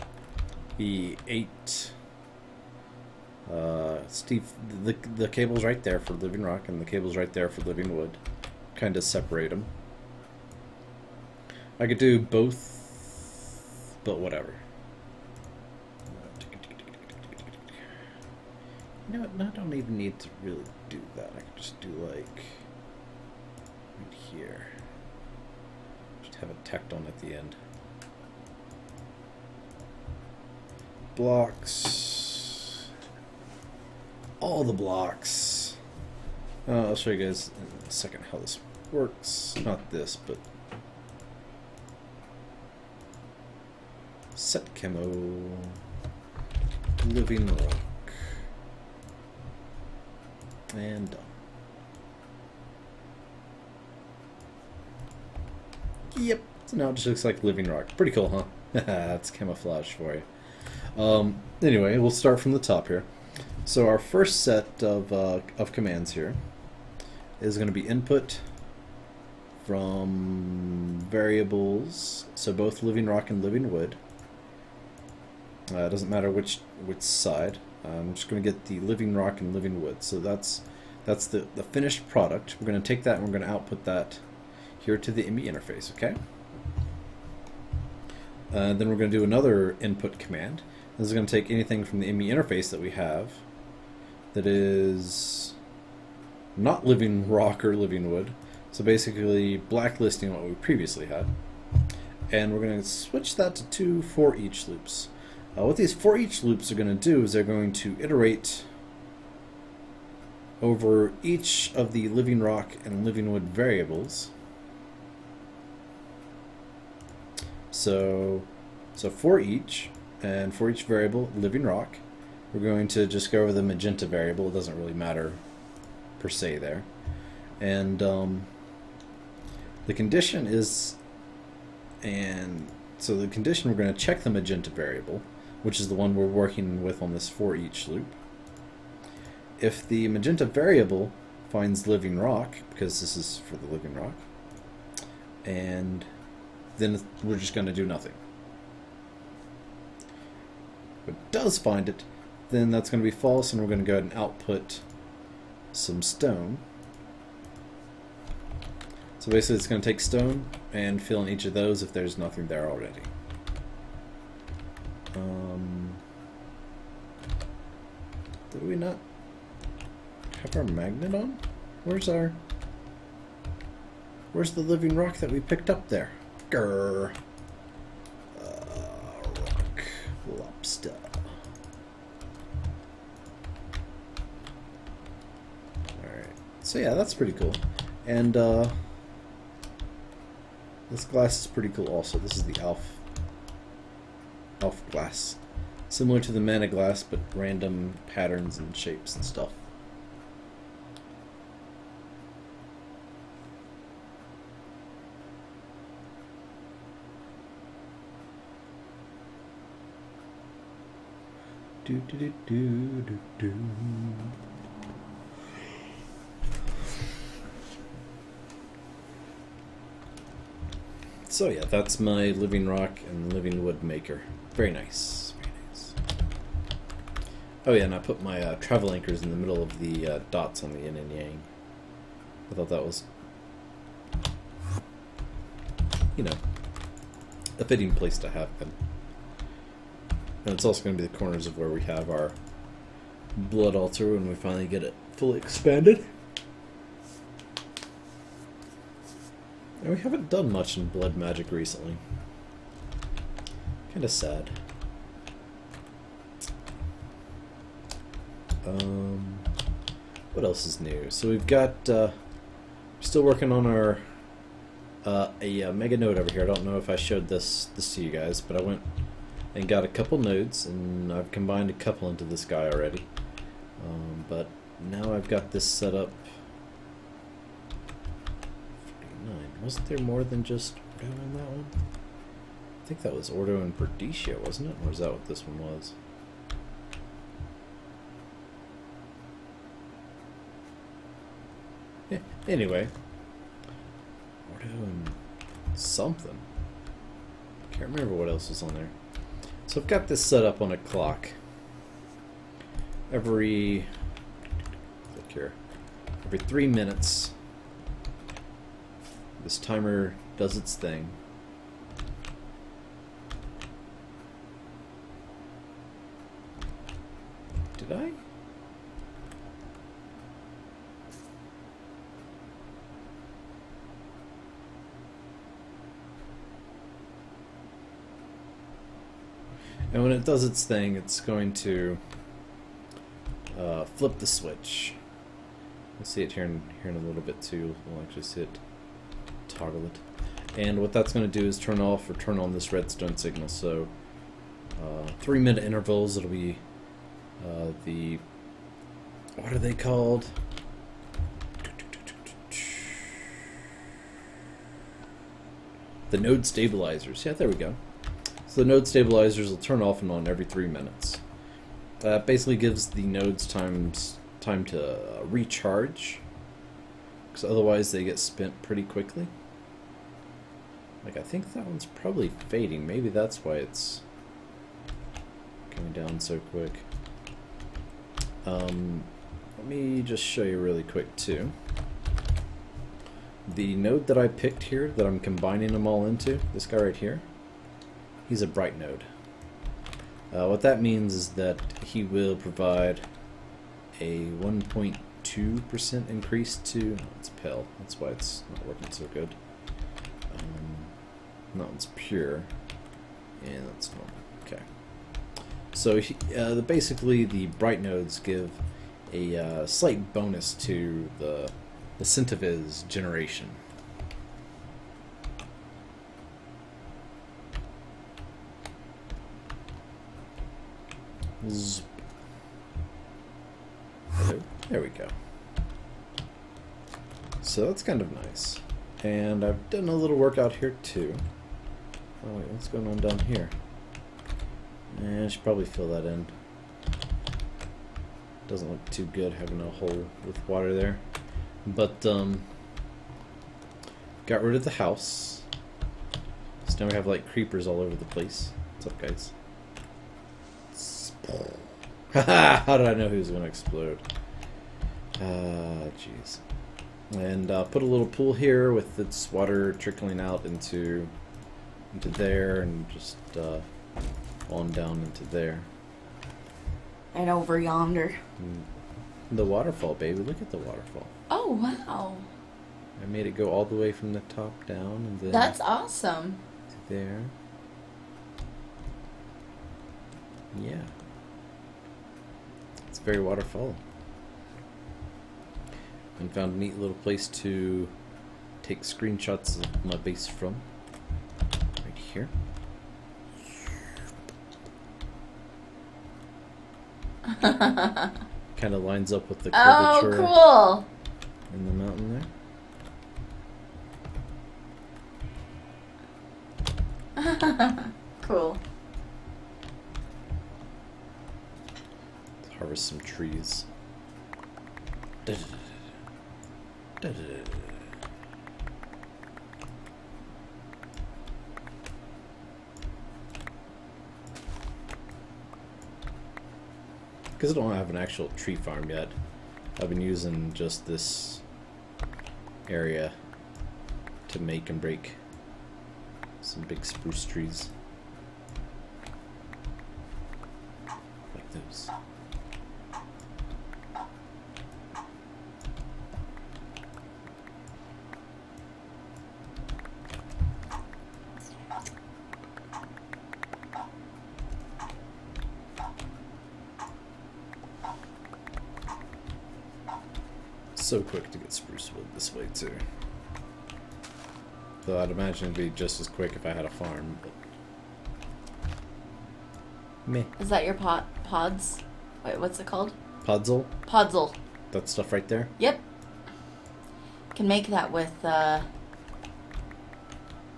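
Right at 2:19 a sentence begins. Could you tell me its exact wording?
If the magenta variable finds living rock, because this is for the living rock, and then we're just going to do nothing.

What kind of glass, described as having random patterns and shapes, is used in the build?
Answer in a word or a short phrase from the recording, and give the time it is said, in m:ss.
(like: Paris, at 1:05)
Elf glass, at 3:12.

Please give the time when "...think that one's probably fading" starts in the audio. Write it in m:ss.
6:11.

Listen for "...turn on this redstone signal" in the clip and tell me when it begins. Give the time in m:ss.
5:42.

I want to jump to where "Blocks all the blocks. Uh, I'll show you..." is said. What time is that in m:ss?
0:31.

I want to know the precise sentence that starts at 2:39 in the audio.
So basically it's going to take stone and fill in each of those if there's nothing there already.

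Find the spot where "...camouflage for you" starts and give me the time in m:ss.
0:59.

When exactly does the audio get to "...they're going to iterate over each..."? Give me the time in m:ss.
1:47.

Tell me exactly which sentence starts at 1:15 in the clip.
Uh, it uh, doesn't matter which which side.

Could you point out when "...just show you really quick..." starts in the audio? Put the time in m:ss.
6:20.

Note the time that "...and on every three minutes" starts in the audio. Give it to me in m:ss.
6:00.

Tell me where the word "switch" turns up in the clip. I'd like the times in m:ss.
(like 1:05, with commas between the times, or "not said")
1:42, 5:34.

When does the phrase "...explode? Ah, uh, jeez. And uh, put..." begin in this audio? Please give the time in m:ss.
7:33.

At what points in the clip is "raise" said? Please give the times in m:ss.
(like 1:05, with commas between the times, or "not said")
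not said.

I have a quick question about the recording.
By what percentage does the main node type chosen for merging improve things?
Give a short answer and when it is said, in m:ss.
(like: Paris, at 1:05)
1.2%, at 6:34.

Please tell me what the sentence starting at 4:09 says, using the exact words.
And we haven't done much in blood magic recently.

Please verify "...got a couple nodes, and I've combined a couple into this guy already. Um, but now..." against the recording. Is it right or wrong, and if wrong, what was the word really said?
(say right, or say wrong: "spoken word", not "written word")
right.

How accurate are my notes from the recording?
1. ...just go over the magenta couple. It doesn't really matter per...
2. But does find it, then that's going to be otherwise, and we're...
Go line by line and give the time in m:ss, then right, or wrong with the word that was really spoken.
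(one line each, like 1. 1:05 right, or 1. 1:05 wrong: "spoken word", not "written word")
1. 2:03 wrong: "variable", not "couple"
2. 2:31 wrong: "false", not "otherwise".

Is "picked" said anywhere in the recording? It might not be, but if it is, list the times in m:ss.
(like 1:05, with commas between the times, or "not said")
2:55, 6:24.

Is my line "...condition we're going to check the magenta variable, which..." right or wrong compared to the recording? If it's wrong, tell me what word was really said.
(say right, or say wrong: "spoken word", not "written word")
right.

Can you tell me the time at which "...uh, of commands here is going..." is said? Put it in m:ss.
1:05.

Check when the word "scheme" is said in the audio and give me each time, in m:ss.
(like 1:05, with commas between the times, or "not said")
not said.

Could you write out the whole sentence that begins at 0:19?
You know what, I don't even need to really do that.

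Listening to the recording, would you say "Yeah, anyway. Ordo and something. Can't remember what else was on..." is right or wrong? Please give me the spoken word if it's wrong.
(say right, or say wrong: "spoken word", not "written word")
right.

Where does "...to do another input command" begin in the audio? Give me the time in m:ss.
1:29.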